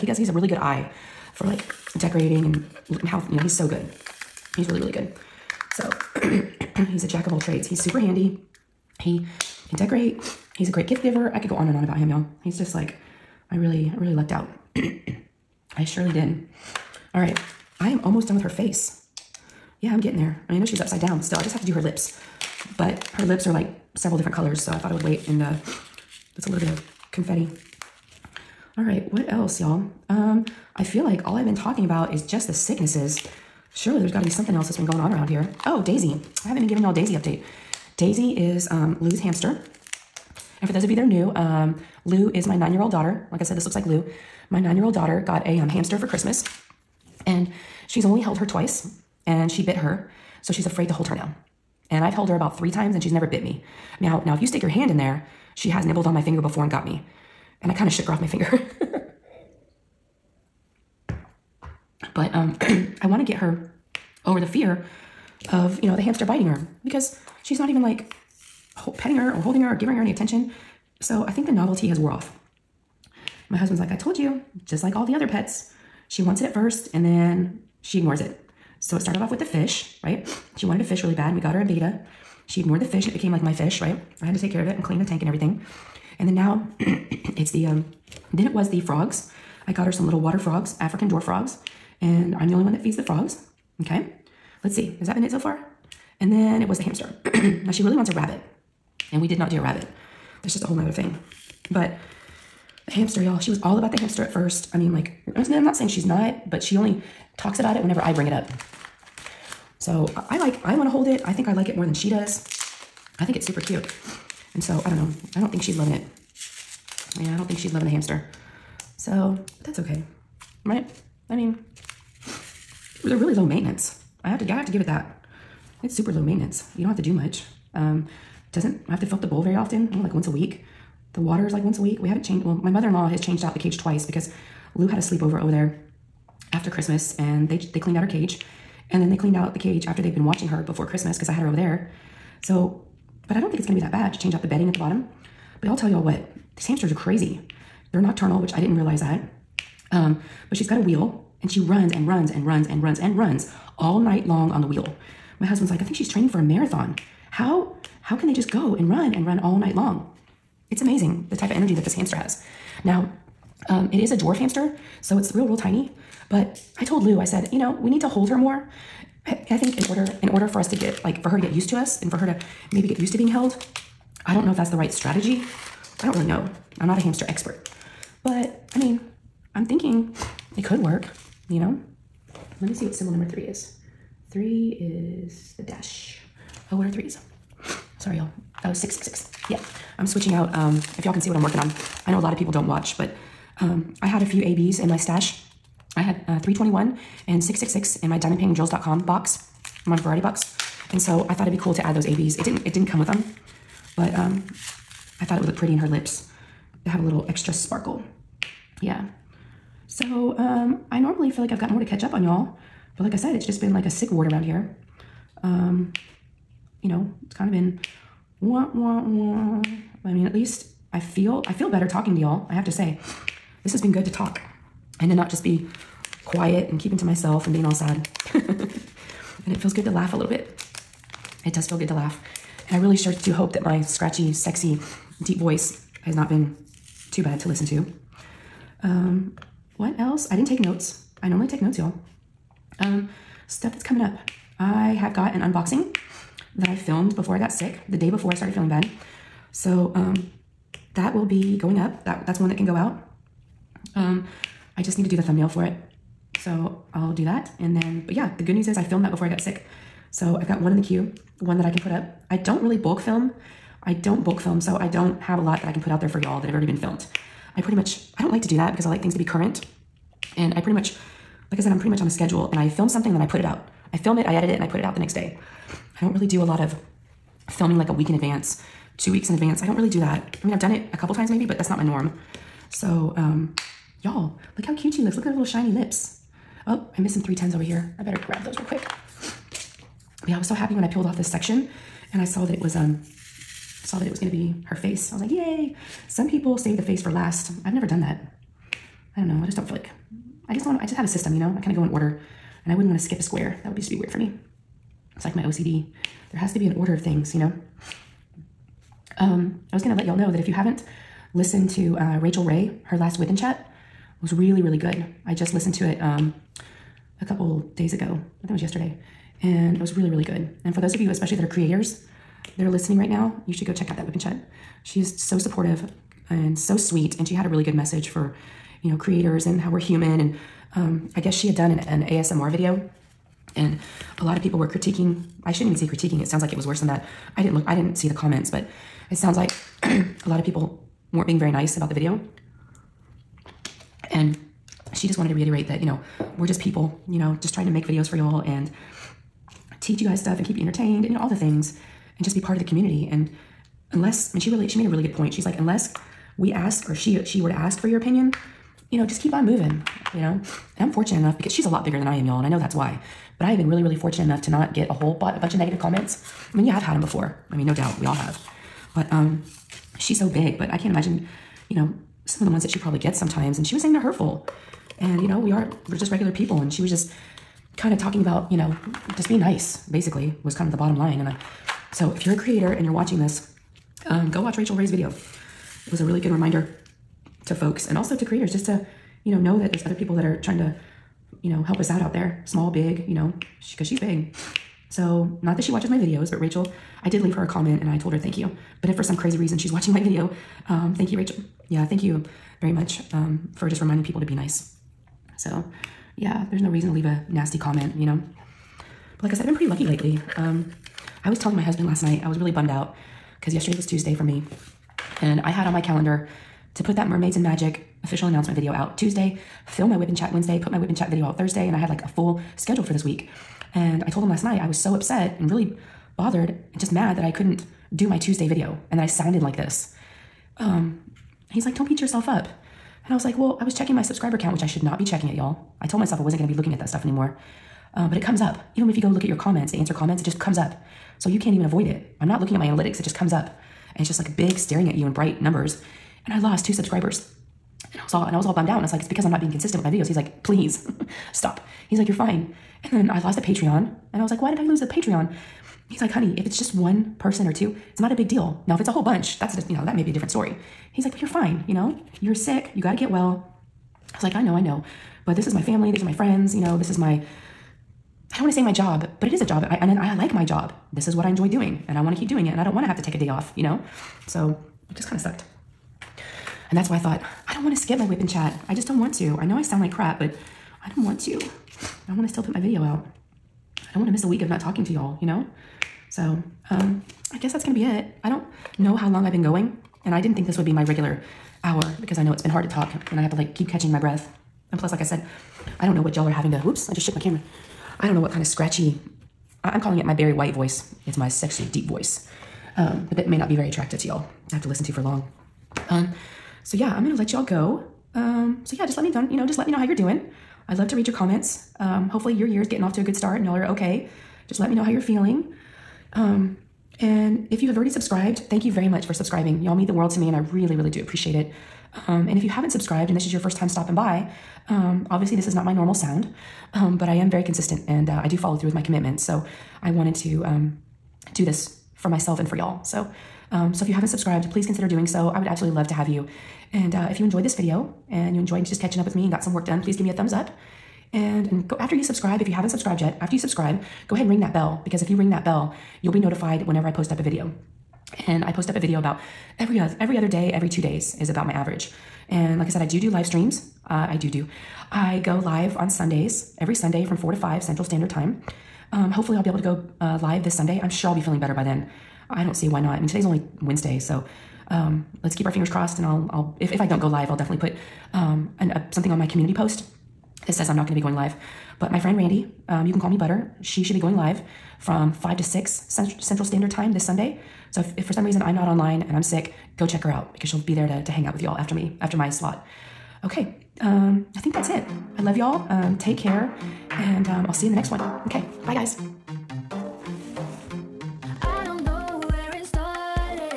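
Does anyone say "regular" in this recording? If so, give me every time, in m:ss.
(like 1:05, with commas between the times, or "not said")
6:16, 8:10.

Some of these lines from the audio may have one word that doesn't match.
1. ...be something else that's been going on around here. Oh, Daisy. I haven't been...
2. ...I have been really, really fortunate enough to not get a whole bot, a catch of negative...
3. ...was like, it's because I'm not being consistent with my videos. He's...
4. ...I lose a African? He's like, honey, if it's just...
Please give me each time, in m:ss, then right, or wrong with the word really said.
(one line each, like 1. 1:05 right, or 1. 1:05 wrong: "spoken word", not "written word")
1. 0:34 right
2. 6:03 wrong: "bunch", not "catch"
3. 7:28 right
4. 7:34 wrong: "Patreon", not "African".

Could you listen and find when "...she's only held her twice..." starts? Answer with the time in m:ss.
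0:47.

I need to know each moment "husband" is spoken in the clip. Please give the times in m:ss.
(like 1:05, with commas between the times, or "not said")
1:13, 2:35, 6:51.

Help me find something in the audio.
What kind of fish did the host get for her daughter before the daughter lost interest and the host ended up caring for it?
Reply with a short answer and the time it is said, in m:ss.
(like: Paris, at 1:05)
beta, at 1:21.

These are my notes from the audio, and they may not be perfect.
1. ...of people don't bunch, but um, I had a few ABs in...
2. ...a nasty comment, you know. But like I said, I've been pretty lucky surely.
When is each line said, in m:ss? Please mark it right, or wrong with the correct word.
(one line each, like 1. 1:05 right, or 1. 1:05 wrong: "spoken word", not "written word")
1. 3:12 wrong: "watch", not "bunch"
2. 6:47 wrong: "lately", not "surely".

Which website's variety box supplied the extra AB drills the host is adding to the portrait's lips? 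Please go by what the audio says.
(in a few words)
diamondpaintingdrills.com.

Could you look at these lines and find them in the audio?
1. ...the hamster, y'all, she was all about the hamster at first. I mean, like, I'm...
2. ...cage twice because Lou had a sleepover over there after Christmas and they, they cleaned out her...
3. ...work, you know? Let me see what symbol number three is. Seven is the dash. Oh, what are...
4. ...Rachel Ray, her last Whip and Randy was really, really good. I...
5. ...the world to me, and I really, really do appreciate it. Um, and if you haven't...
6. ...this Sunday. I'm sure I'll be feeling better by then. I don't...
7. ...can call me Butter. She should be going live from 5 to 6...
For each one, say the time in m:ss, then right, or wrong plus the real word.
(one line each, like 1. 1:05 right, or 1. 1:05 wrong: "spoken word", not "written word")
1. 1:42 right
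2. 2:13 right
3. 3:00 wrong: "Three", not "Seven"
4. 5:12 wrong: "Chat", not "Randy"
5. 8:39 right
6. 9:20 right
7. 9:32 right.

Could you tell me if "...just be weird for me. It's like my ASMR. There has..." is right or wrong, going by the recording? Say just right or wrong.
wrong.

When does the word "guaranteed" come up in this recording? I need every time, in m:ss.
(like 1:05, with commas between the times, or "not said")
not said.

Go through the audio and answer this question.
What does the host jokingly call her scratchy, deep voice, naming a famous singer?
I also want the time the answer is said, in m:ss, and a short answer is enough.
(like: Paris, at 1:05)
Barry White voice, at 8:20.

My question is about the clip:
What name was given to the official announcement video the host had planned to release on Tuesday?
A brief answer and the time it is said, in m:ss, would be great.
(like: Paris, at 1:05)
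Mermaids and Magic, at 6:57.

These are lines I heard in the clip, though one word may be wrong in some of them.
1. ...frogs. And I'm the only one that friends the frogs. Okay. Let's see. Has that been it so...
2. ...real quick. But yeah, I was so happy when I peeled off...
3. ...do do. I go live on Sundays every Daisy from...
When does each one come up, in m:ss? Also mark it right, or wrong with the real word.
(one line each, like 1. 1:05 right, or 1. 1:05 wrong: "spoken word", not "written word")
1. 1:31 wrong: "feeds", not "friends"
2. 4:48 right
3. 9:14 wrong: "Sunday", not "Daisy".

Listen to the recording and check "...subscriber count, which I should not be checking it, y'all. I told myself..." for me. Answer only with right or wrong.
right.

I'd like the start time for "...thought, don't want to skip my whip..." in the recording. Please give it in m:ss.
7:56.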